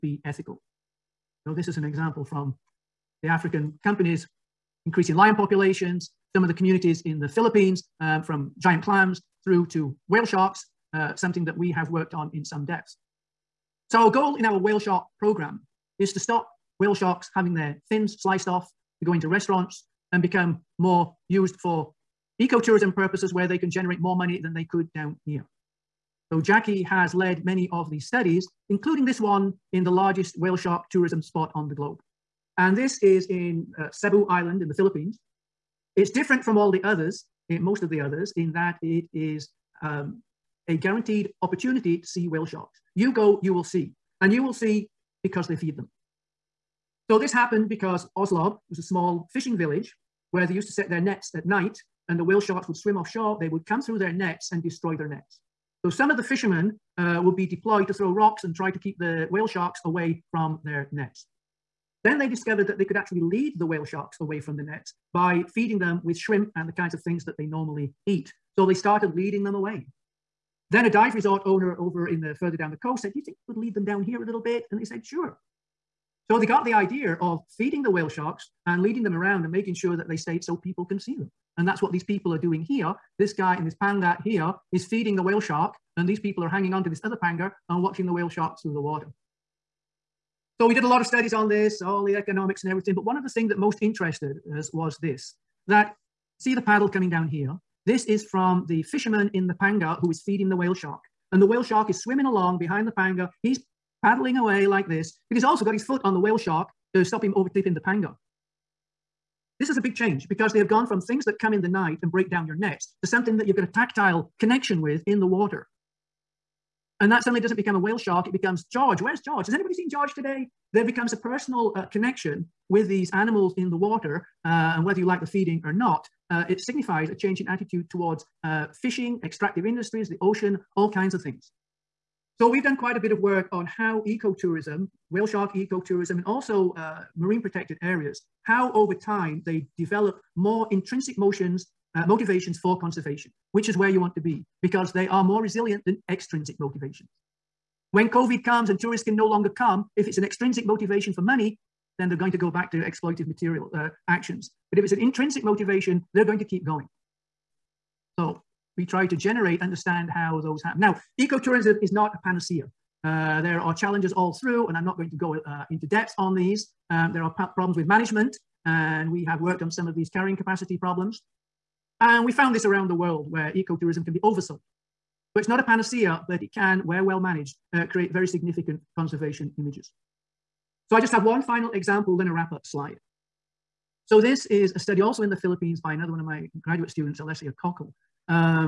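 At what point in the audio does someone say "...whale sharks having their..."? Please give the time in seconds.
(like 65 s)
16 s.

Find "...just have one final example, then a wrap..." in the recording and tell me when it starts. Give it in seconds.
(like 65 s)
180 s.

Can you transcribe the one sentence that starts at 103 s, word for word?
He's paddling away like this, but he's also got his foot on the whale shark to stop him overtipping the panga.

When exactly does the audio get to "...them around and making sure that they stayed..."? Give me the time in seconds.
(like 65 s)
79 s.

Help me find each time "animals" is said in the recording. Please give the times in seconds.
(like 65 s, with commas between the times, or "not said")
123 s.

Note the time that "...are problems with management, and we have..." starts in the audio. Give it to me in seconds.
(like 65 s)
167 s.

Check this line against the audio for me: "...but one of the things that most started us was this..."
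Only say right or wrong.
wrong.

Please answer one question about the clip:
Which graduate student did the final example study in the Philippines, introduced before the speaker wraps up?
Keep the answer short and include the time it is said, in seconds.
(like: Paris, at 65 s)
Alessia Kockel, at 187 s.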